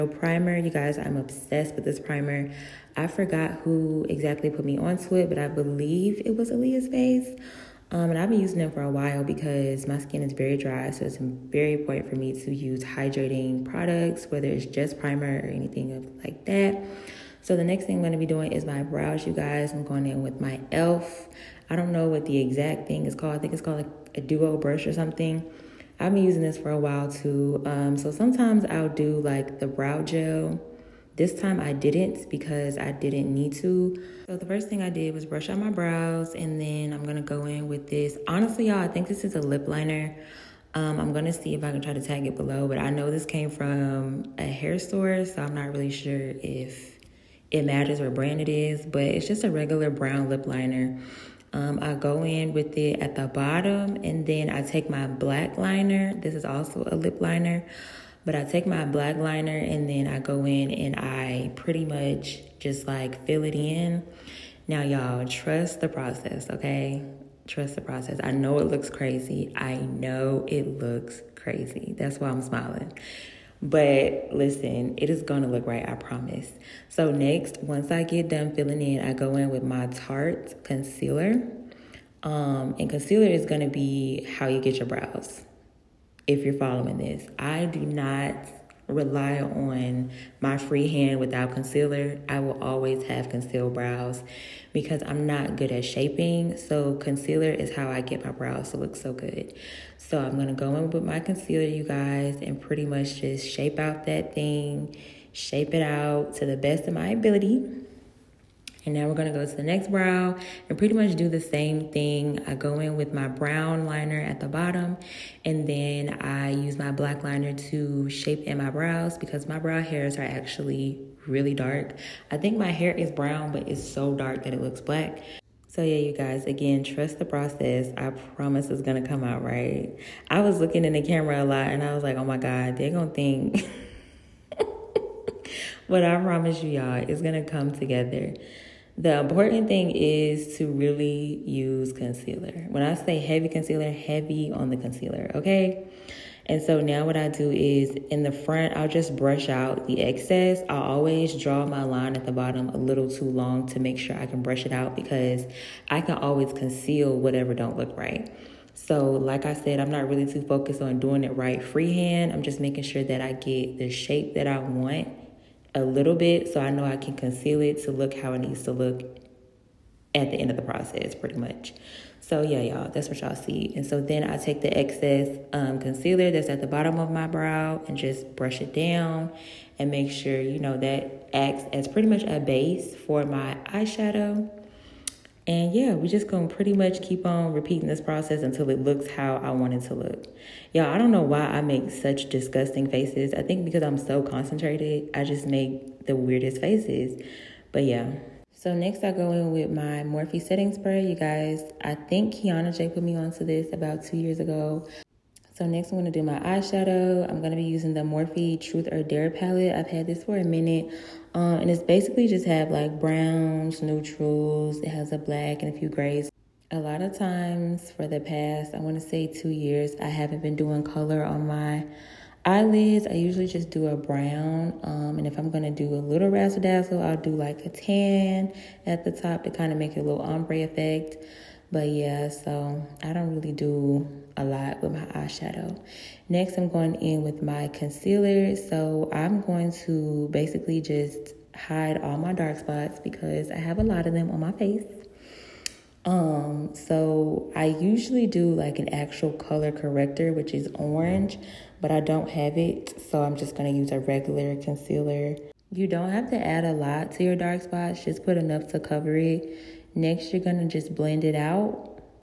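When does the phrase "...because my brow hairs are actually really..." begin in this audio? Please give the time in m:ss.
1:59.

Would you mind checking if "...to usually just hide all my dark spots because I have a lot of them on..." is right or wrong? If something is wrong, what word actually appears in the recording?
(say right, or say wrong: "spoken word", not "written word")
wrong: "basically", not "usually".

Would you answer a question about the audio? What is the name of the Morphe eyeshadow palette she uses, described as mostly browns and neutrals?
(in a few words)
Truth or Dare.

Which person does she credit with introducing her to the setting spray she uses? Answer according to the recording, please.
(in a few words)
Kiana J.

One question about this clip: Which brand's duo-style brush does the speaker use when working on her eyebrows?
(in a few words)
e.l.f.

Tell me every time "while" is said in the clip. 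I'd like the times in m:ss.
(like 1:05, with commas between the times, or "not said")
0:08, 0:26.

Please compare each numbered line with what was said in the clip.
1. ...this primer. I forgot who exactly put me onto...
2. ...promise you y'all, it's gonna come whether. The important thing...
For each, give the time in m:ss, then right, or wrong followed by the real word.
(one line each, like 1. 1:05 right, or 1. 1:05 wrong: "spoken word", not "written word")
1. 0:01 right
2. 2:16 wrong: "together", not "whether".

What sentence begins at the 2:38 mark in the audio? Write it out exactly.
So like I said, I'm not really too focused on doing it right freehand.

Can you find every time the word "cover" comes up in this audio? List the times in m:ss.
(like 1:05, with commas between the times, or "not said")
4:18.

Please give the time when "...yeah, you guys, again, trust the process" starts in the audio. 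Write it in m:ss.
2:05.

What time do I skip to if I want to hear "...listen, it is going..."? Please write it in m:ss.
1:14.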